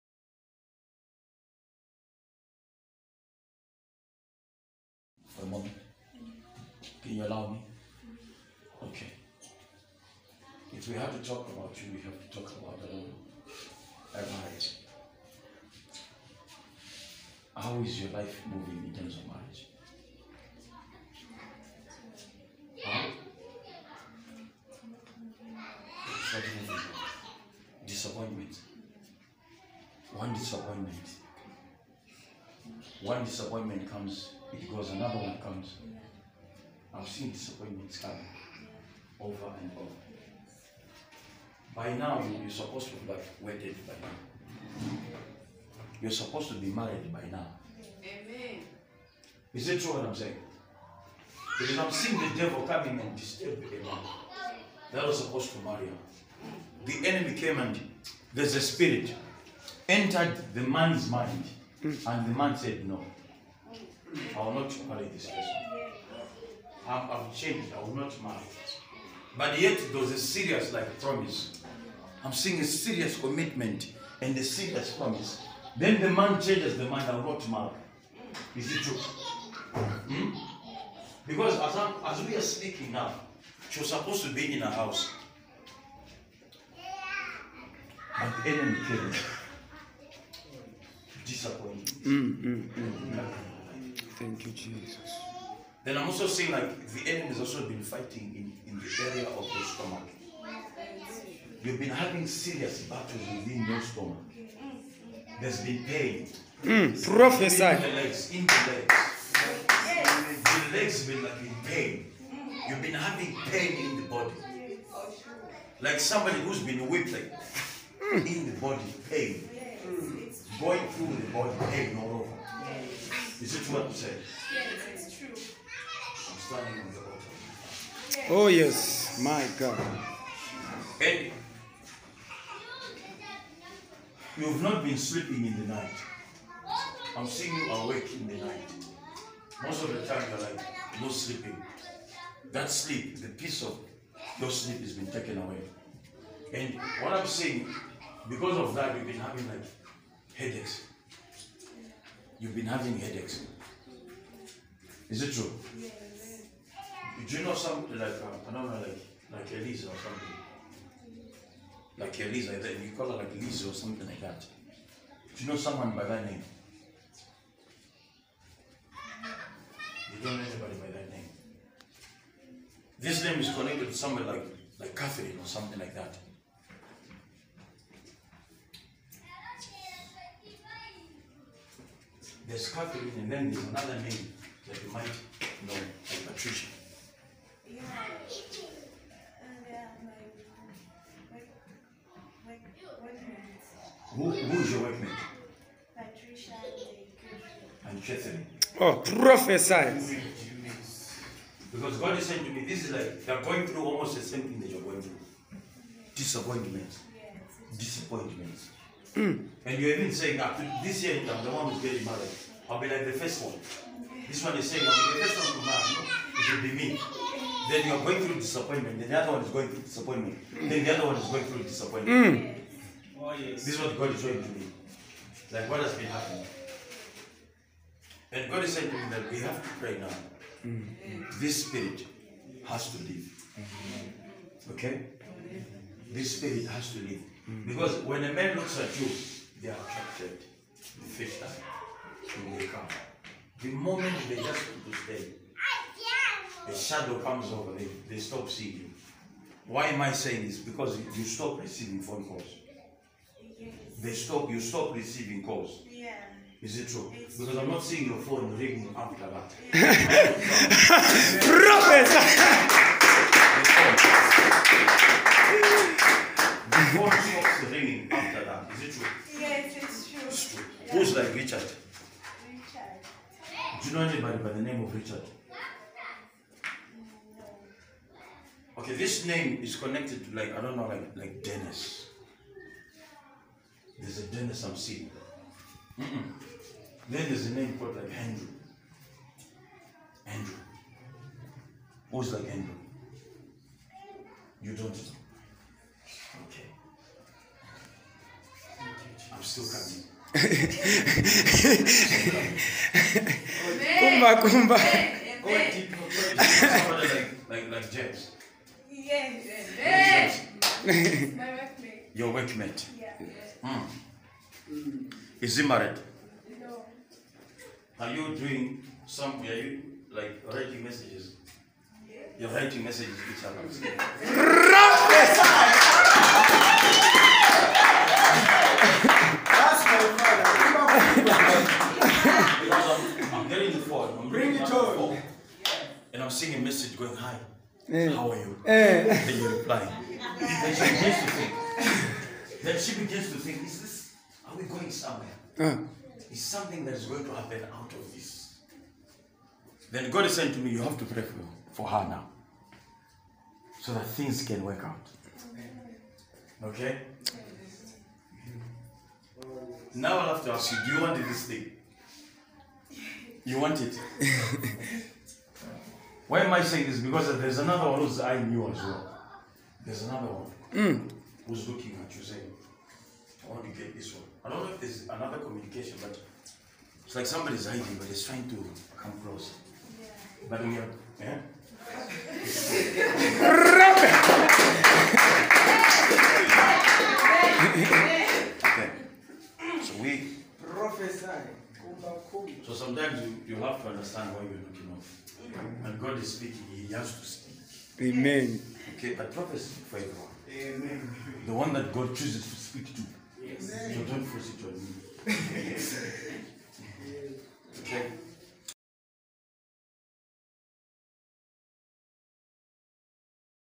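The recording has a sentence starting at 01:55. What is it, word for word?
Like somebody who's been whipped like hmm.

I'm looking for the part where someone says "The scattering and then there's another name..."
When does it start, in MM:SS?
03:02.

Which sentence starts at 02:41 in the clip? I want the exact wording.
Like Elisa, you call her like Elisa or something like that.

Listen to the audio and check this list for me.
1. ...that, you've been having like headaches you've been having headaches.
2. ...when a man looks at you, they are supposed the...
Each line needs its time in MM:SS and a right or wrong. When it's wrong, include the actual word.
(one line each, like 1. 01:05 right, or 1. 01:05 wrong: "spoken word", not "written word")
1. 02:28 right
2. 03:58 wrong: "attracted", not "supposed".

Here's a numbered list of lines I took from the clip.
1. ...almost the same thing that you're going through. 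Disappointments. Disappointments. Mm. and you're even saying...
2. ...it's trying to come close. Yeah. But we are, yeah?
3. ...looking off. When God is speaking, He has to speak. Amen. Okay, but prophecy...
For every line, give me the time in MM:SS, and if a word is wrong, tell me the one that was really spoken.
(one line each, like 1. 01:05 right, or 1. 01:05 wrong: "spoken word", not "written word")
1. 03:23 right
2. 06:18 right
3. 06:34 right.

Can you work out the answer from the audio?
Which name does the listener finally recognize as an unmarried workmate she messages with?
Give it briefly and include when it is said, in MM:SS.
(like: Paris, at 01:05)
James, at 05:07.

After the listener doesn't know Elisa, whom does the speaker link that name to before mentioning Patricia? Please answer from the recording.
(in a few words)
Catherine.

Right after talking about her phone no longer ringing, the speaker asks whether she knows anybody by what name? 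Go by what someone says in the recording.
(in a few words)
Richard.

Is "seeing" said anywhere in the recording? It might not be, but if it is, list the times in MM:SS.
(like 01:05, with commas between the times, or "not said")
00:51, 01:12, 01:36, 02:17, 04:08, 04:17, 04:44.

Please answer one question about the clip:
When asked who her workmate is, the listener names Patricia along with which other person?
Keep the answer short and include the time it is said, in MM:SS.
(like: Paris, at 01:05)
Chetan, at 03:18.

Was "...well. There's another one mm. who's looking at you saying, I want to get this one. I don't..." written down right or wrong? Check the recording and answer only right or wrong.
right.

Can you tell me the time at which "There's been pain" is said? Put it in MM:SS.
01:45.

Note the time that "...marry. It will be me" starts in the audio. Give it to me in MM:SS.
03:35.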